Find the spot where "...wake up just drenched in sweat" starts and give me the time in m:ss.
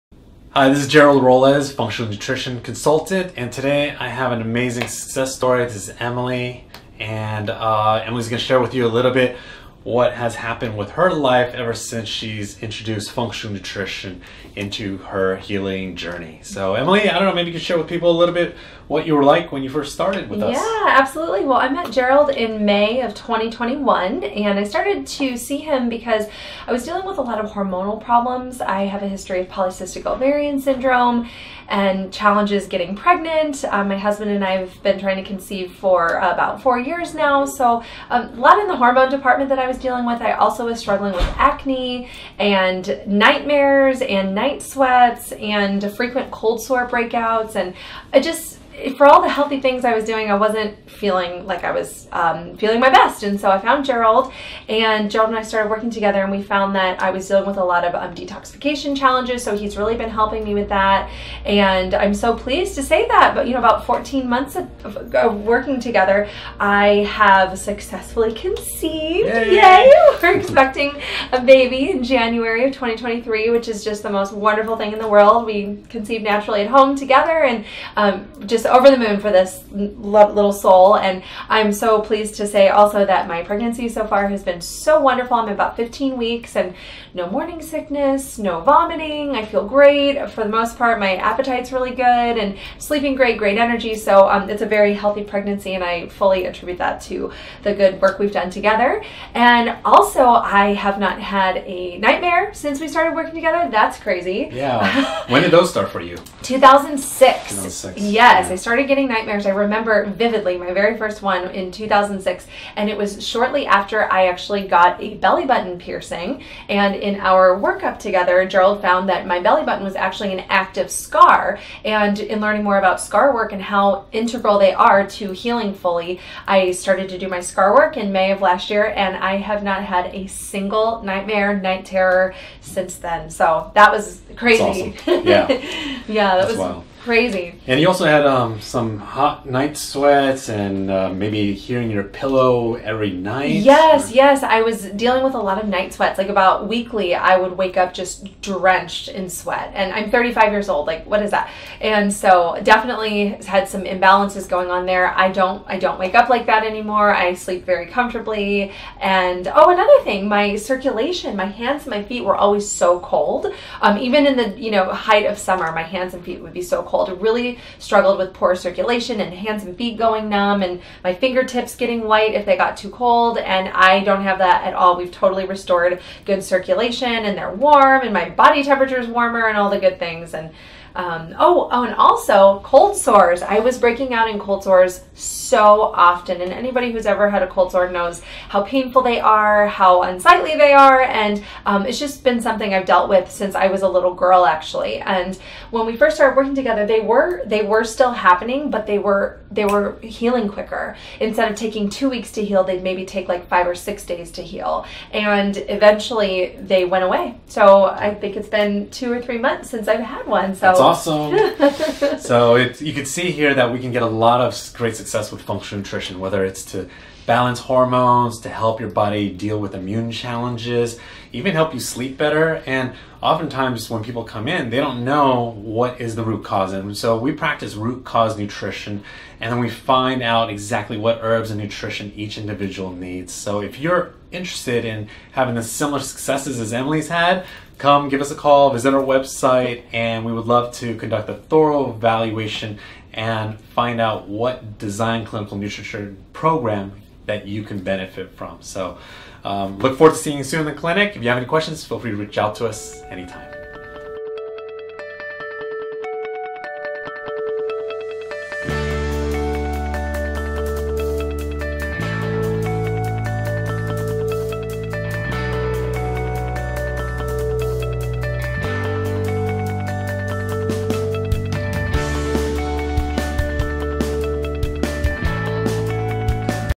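2:27.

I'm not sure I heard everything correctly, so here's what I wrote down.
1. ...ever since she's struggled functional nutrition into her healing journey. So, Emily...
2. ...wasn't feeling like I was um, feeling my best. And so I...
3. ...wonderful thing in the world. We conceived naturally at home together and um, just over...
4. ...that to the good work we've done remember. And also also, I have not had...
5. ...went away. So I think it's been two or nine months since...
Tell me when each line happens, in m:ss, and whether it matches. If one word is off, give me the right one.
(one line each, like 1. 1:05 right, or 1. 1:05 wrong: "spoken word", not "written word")
1. 0:11 wrong: "introduced", not "struggled"
2. 0:50 right
3. 1:14 right
4. 1:36 wrong: "together", not "remember"
5. 3:26 wrong: "three", not "nine".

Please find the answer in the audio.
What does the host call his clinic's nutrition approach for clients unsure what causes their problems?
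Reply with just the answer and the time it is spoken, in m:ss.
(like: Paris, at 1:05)
root cause nutrition, at 3:47.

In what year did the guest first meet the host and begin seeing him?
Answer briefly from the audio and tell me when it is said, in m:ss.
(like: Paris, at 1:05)
2021, at 0:23.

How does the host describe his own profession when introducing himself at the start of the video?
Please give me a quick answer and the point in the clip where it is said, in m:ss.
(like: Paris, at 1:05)
functional nutrition consultant, at 0:01.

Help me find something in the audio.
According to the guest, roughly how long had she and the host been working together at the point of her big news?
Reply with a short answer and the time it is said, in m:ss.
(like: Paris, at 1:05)
14 months, at 1:03.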